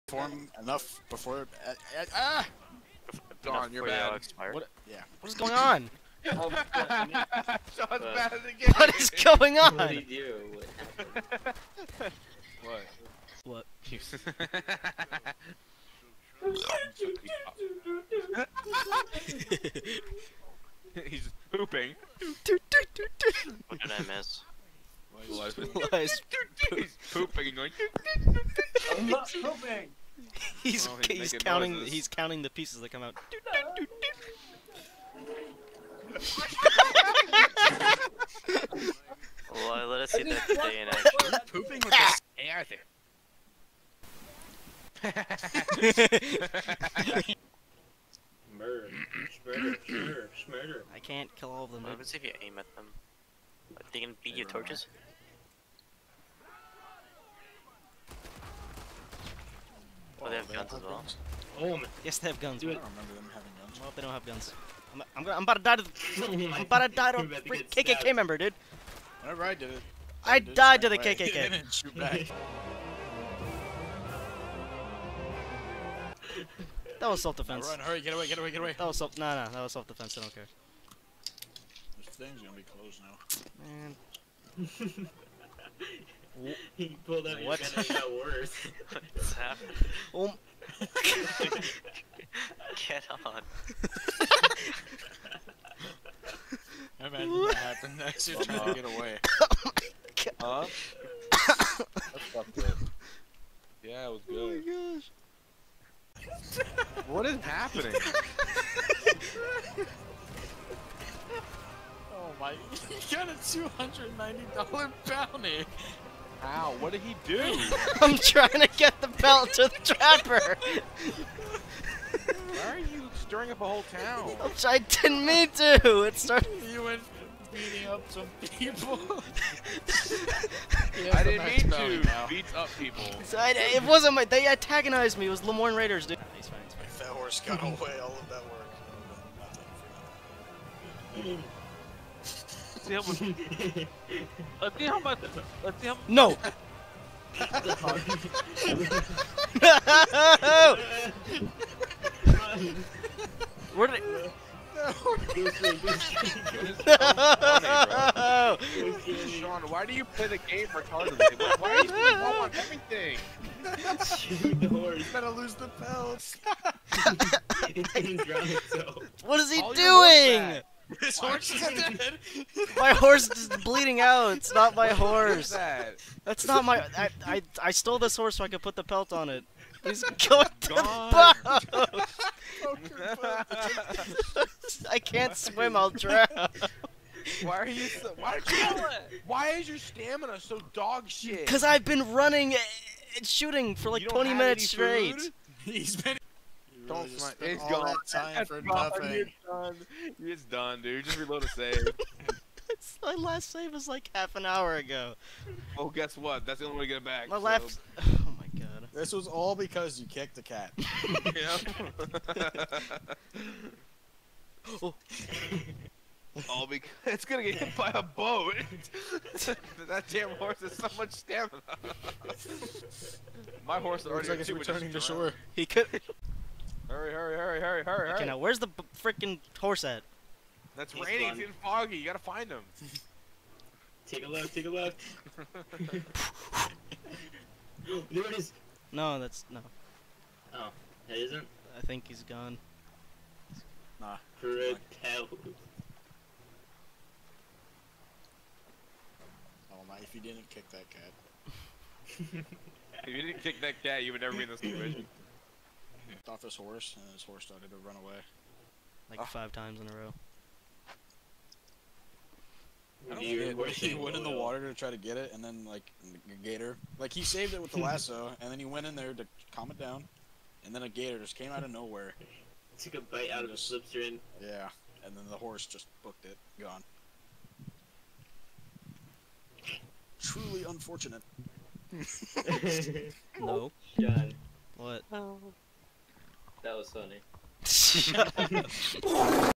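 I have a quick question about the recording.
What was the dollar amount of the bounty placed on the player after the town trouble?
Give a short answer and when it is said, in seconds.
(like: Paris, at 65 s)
$290, at 113 s.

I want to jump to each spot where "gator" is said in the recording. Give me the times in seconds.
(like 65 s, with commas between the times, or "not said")
266 s, 270 s.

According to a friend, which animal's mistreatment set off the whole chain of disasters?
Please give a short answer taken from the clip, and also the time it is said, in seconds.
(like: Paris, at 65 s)
the cat, at 210 s.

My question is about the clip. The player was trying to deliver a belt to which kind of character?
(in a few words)
the trapper.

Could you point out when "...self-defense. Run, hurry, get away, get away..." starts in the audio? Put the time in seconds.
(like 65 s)
77 s.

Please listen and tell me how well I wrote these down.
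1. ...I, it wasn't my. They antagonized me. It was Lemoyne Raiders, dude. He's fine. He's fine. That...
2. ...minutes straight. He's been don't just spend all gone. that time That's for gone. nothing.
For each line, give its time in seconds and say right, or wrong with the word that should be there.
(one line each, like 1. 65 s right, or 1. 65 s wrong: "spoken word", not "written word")
1. 133 s right
2. 194 s right.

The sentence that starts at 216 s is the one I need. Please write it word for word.
all because it's gonna get hit by a boat.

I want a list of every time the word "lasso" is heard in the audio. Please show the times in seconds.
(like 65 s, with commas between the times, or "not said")
267 s.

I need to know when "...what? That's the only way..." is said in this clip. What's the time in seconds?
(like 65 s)
206 s.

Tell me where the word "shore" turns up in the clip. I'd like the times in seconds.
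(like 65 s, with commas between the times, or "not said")
224 s.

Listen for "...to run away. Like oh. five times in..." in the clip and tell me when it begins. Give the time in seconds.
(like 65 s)
257 s.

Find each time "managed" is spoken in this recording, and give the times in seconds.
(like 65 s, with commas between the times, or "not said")
not said.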